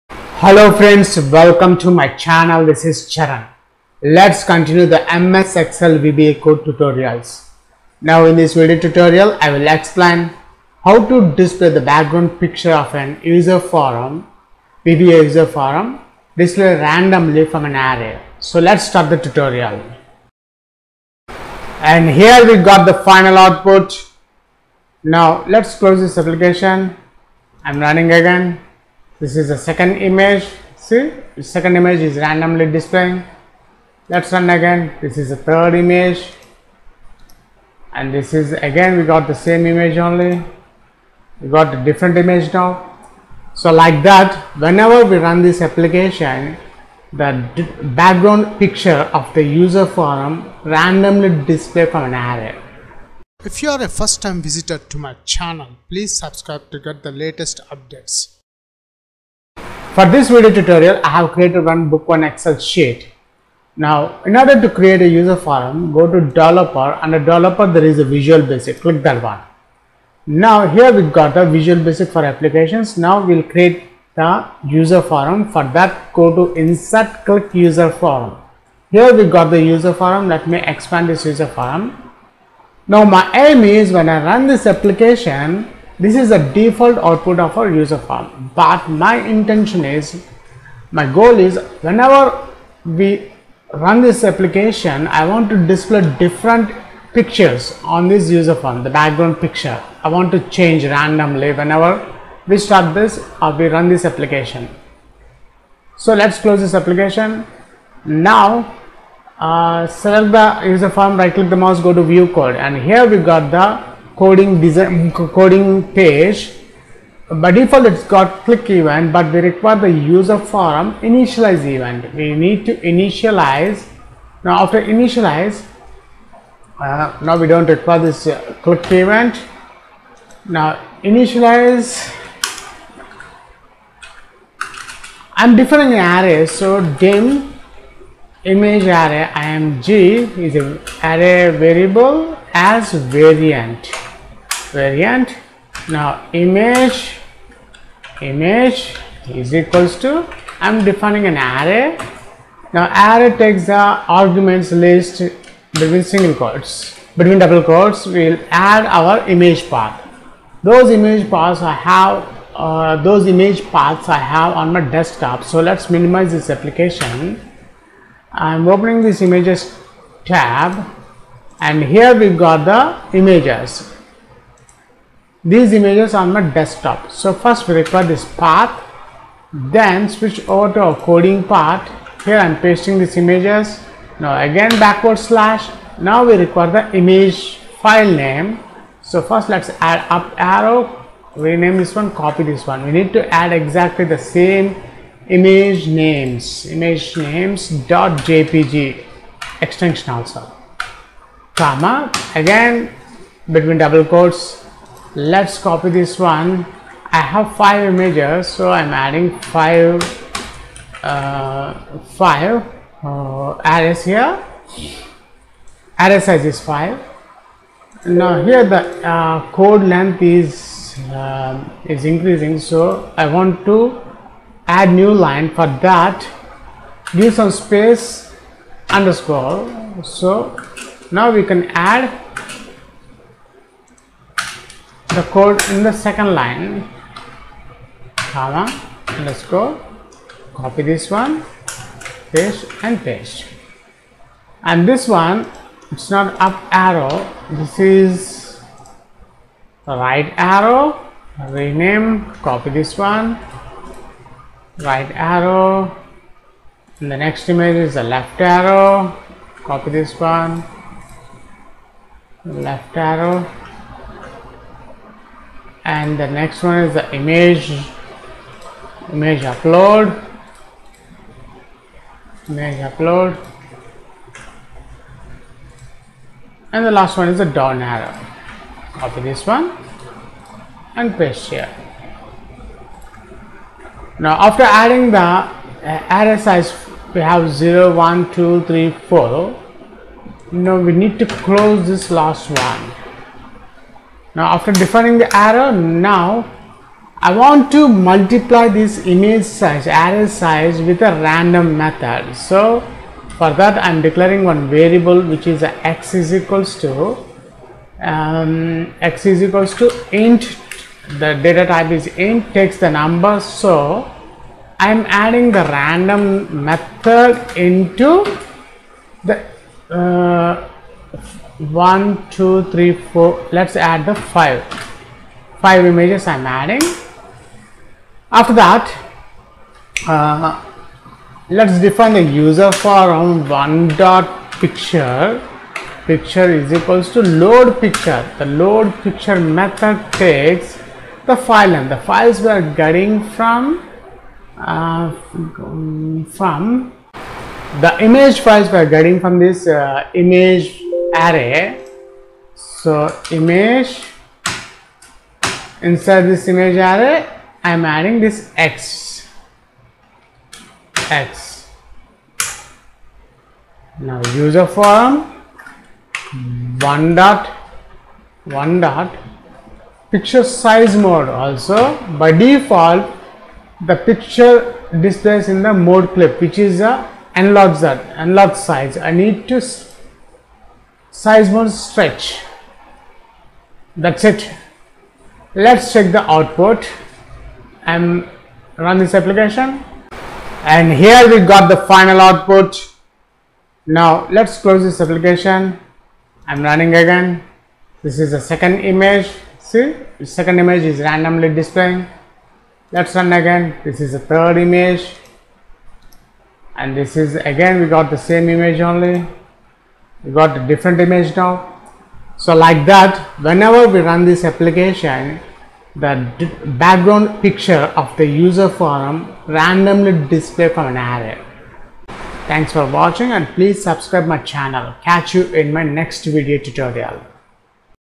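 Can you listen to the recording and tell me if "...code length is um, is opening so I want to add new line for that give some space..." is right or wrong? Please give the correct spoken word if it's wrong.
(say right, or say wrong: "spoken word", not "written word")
wrong: "increasing", not "opening".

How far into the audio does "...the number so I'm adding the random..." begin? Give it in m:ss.
5:12.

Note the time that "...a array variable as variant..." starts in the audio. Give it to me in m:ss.
2:20.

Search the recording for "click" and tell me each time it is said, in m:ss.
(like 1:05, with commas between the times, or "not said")
1:08, 1:17, 1:51, 1:58, 2:08.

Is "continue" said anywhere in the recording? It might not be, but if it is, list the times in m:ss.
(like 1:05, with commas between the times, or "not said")
0:04.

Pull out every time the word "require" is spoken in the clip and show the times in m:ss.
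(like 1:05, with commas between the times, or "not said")
1:59, 2:07, 2:57, 3:06.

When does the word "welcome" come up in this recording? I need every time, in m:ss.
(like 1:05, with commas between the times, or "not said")
0:01.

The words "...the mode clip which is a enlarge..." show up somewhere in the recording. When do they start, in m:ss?
6:15.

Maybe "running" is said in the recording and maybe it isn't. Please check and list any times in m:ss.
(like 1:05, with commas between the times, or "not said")
0:27, 6:36.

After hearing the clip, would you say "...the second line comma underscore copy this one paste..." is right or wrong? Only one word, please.
right.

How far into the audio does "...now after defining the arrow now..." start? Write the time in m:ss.
4:54.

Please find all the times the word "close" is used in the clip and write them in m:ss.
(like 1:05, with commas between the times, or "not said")
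0:25, 1:46, 4:51, 6:34.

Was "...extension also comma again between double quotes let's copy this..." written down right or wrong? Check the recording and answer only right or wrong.
right.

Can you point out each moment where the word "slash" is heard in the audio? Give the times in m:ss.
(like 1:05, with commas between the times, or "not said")
3:05.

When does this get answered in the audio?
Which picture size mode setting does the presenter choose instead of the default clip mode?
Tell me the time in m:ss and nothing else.
6:21.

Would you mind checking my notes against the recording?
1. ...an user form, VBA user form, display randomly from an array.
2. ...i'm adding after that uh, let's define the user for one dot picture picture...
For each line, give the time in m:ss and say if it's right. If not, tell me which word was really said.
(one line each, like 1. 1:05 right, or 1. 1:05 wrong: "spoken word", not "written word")
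1. 0:12 right
2. 5:26 right.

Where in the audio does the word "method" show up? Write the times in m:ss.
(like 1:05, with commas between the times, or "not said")
5:01, 5:16, 5:39.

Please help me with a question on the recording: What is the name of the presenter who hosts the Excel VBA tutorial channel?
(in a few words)
Charan.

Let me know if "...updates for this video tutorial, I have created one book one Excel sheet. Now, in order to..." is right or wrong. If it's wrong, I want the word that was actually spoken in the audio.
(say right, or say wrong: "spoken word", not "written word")
right.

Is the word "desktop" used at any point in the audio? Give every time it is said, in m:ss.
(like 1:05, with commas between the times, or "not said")
2:44, 2:56.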